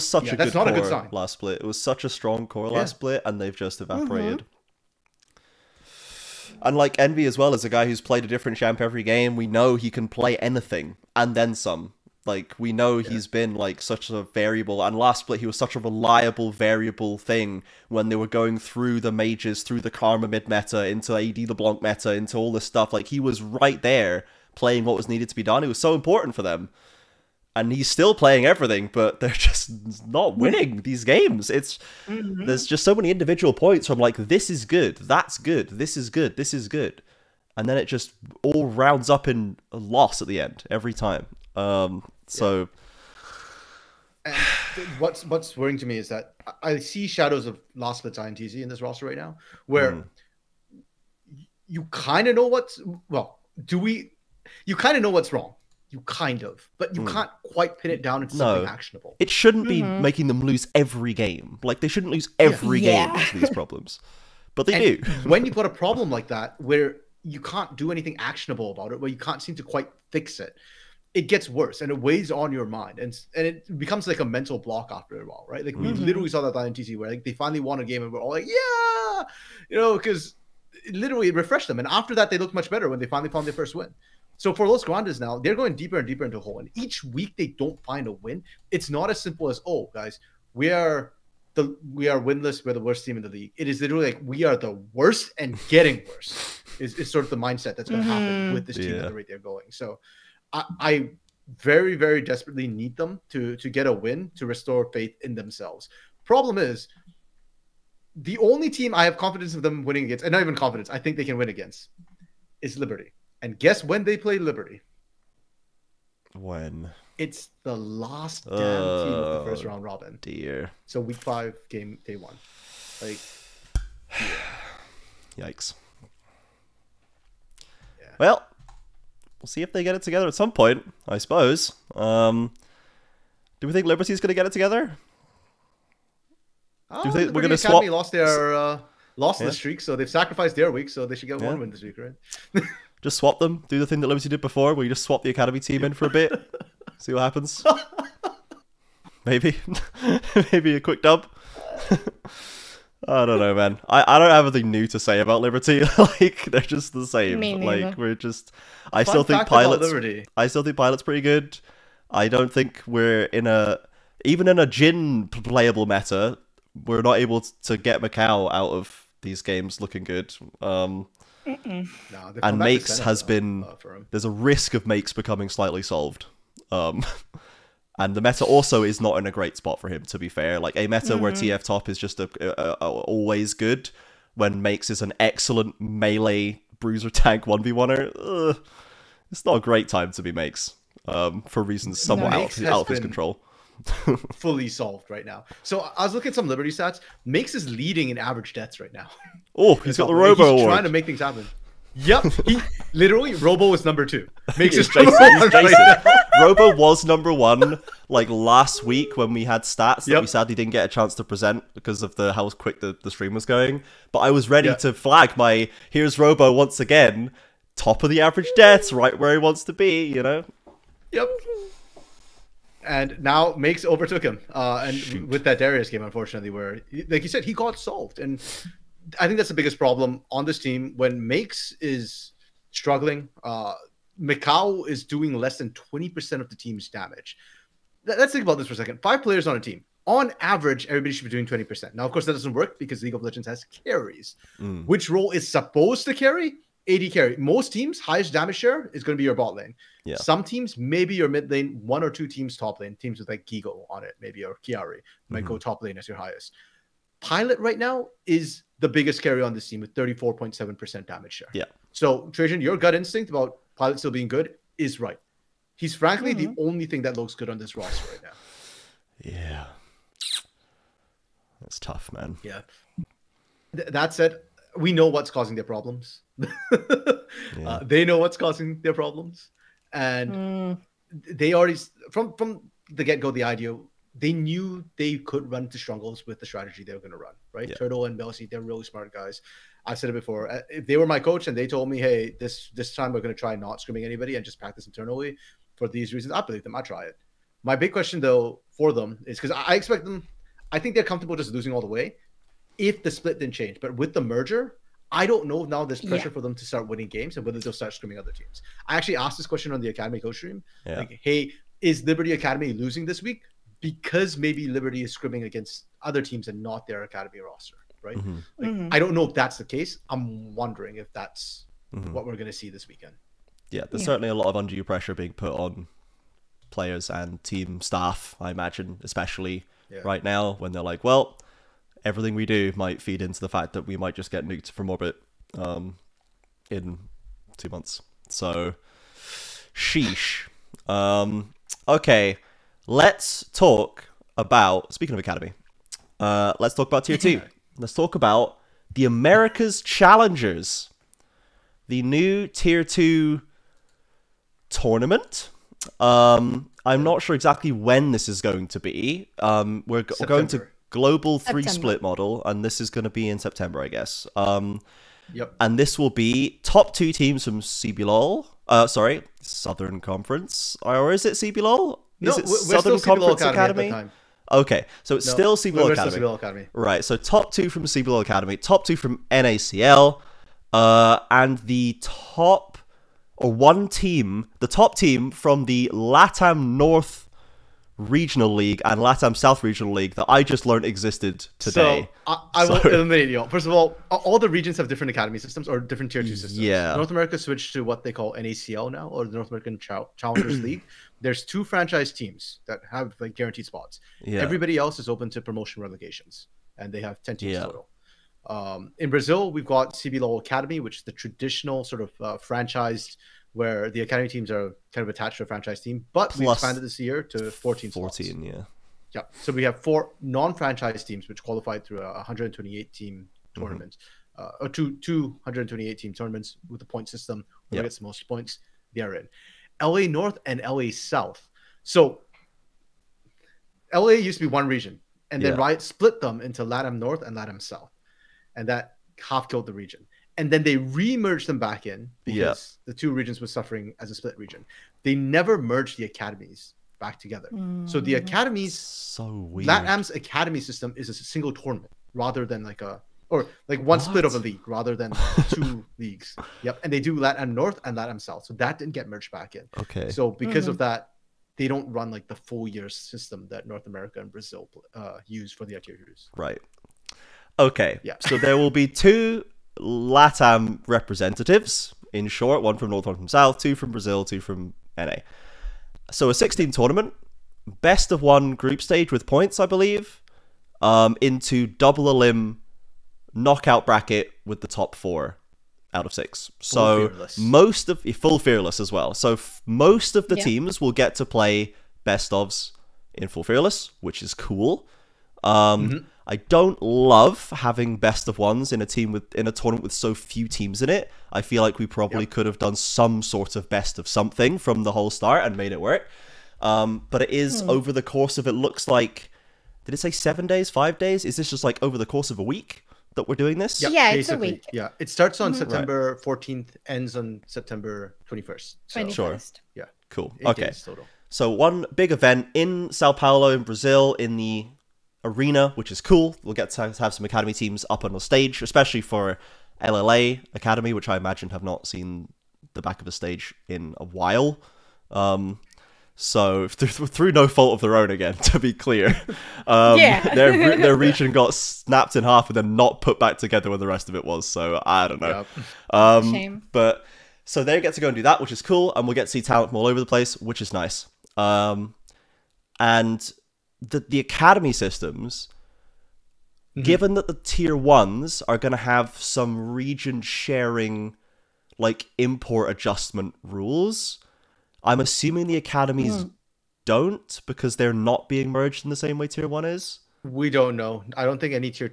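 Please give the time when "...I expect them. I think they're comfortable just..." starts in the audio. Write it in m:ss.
4:59.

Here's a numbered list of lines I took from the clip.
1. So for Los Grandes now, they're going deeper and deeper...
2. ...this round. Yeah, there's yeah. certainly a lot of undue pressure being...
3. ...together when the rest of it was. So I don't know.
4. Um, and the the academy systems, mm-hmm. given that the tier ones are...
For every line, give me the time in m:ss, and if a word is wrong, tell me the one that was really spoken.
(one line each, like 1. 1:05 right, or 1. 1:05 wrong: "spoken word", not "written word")
1. 1:24 right
2. 5:22 wrong: "weekend", not "round"
3. 9:03 right
4. 9:11 right.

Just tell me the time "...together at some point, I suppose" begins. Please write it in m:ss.
2:10.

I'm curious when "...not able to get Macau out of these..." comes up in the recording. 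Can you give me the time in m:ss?
2:47.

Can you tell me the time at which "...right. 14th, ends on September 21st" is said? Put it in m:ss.
8:36.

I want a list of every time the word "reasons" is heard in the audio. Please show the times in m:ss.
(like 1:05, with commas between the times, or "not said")
3:11, 4:56.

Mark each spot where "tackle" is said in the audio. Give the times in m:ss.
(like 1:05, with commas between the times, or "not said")
not said.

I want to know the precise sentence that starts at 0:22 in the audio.
Like he was right there playing what was needed to be done.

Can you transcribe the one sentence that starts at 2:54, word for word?
There's a risk of Makes becoming slightly solved.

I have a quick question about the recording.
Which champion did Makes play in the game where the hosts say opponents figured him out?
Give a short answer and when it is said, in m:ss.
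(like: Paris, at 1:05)
Darius, at 3:45.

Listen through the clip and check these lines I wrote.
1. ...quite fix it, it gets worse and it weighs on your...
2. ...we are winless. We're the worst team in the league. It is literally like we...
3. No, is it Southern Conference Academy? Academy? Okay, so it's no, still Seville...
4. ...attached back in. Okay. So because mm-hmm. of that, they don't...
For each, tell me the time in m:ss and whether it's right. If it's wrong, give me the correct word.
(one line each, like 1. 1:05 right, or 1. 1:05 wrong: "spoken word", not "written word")
1. 1:09 right
2. 1:31 right
3. 6:12 right
4. 7:39 wrong: "merged", not "attached".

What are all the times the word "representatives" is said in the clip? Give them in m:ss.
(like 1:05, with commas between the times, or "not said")
7:50.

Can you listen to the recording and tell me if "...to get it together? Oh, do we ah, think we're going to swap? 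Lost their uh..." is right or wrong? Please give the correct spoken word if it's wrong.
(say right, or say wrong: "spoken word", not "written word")
right.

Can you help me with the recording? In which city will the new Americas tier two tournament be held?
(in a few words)
Sao Paulo.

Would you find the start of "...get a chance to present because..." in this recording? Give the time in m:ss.
3:30.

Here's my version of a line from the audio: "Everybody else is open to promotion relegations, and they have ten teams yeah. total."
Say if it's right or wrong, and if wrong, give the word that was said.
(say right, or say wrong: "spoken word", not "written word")
right.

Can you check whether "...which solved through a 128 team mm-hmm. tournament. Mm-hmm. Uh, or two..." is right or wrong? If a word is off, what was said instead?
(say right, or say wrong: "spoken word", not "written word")
wrong: "qualified", not "solved".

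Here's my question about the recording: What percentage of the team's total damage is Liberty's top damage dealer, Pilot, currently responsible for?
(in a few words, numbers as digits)
34.7%.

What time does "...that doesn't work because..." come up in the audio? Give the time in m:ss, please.
4:02.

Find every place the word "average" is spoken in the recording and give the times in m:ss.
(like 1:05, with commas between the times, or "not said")
3:18, 3:38, 4:00.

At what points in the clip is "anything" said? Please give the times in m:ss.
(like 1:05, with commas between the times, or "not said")
0:10, 1:07, 2:34.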